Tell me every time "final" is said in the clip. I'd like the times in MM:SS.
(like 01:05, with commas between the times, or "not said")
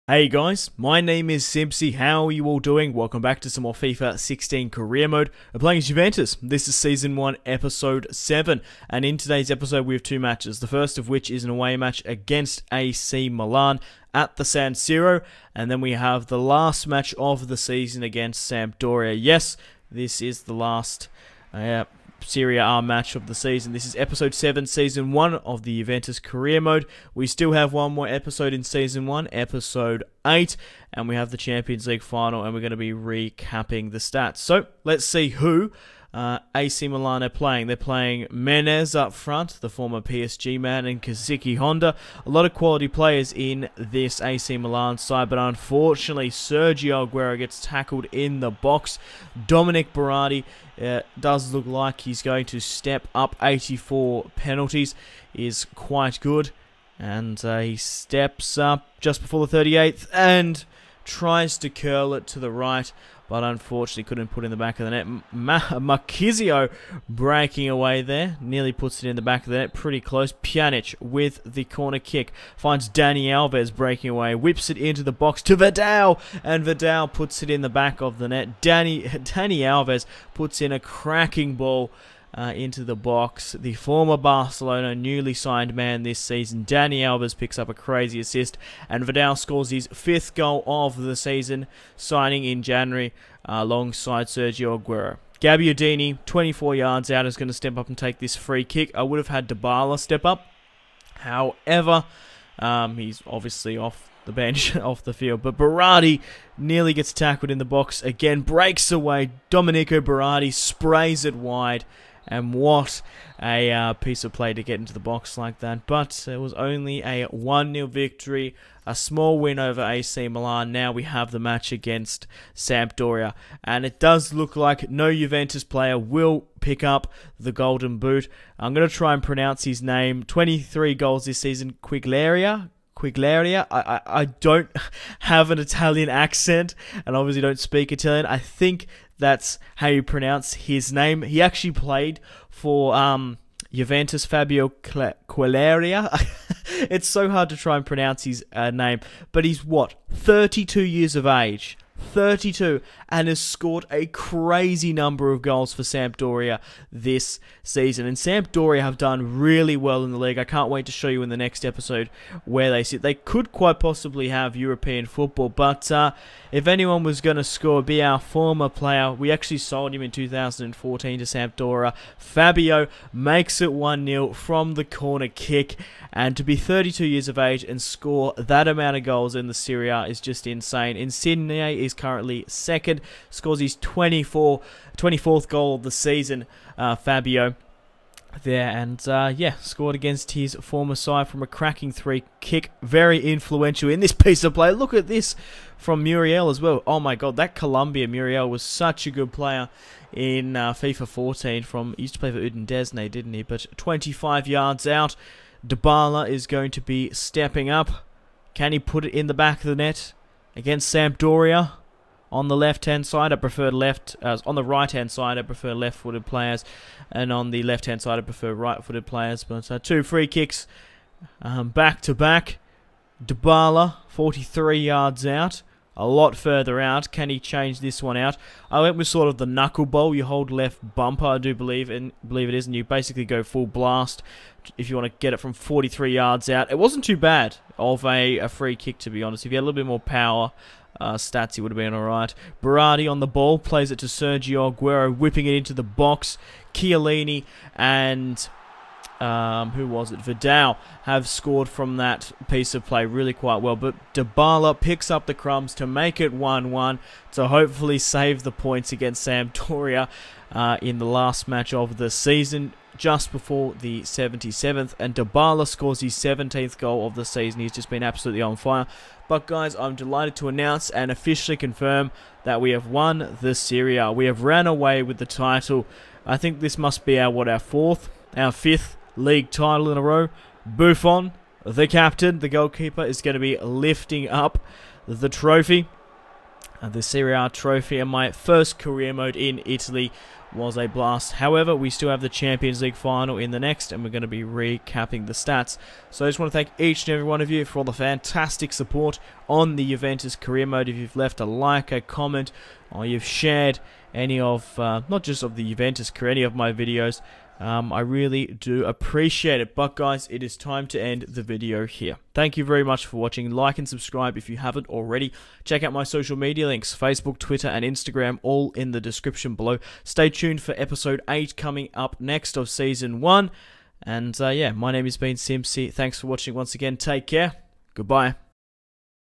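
00:32, 04:52.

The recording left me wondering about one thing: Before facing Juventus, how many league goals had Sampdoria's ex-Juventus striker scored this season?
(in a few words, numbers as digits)
23.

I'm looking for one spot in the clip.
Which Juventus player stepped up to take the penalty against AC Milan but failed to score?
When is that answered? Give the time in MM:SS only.
00:49.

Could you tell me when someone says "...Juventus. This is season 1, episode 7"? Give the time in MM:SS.
00:05.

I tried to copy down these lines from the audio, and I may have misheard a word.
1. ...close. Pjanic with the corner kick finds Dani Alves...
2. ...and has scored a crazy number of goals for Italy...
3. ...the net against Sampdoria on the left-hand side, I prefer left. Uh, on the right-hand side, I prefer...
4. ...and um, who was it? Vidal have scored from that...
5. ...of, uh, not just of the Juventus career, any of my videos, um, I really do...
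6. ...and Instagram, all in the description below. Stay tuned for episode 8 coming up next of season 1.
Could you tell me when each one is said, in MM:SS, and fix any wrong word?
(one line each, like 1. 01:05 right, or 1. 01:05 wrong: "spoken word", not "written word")
1. 01:10 right
2. 02:33 wrong: "Sampdoria", not "Italy"
3. 03:29 right
4. 04:07 right
5. 05:04 right
6. 05:17 right.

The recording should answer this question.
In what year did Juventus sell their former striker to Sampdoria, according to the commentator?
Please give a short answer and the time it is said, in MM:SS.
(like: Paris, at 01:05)
2014, at 02:50.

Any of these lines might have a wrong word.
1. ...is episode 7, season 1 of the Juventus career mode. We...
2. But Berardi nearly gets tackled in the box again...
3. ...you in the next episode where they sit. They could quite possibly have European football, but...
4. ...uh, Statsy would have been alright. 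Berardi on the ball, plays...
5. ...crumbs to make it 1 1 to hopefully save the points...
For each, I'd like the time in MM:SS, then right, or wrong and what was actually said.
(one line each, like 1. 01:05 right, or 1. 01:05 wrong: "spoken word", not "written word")
1. 00:23 right
2. 01:45 right
3. 02:41 right
4. 04:01 right
5. 04:15 right.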